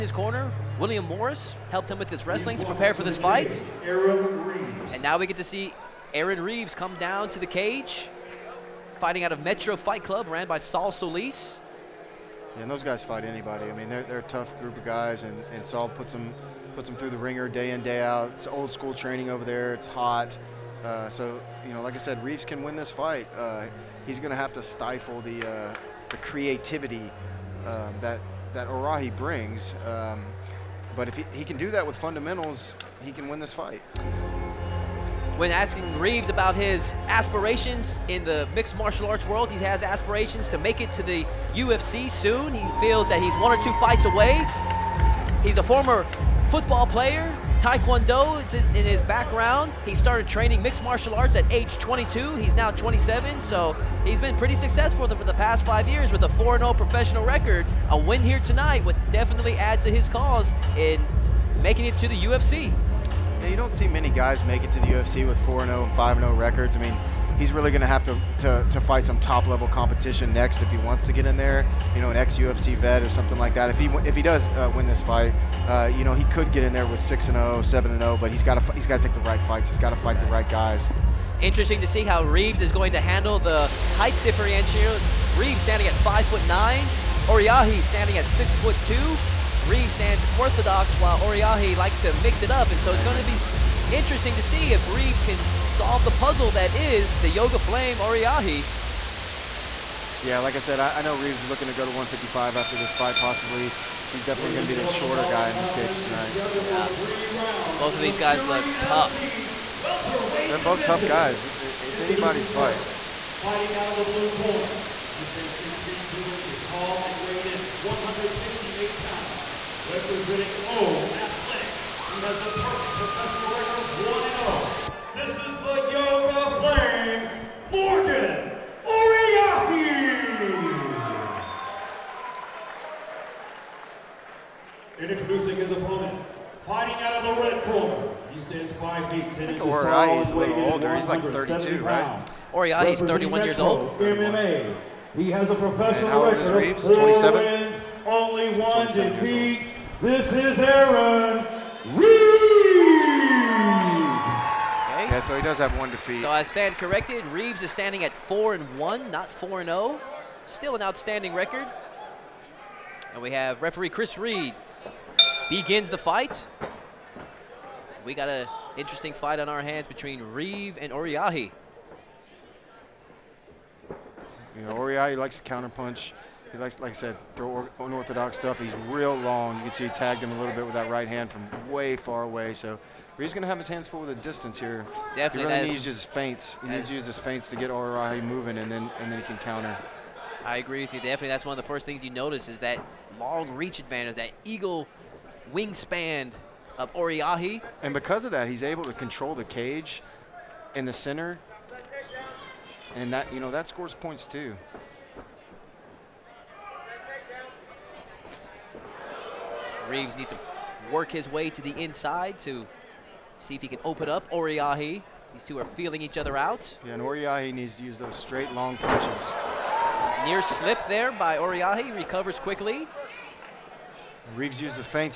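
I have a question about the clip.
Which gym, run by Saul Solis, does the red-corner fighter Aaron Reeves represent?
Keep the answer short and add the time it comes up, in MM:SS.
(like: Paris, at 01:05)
Metro Fight Club, at 00:09.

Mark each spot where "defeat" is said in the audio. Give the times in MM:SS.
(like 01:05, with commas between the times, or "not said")
02:28, 02:35.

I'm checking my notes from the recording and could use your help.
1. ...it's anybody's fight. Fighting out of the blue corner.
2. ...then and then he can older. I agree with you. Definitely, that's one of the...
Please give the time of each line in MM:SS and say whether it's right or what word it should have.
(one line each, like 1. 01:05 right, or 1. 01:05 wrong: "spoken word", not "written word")
1. 01:51 right
2. 03:08 wrong: "counter", not "older".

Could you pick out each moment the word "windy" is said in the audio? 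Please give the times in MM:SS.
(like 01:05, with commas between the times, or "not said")
not said.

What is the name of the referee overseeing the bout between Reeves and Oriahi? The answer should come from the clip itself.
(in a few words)
Chris Reed.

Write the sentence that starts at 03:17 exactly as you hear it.
And because of that, he's able to control the cage in the center, and that you know that scores points too.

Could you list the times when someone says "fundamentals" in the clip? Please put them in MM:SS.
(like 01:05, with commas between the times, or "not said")
00:31.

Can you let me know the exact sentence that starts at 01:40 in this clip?
Yeah, like I said, I, I know Reeves is looking to go to 155 after this fight possibly.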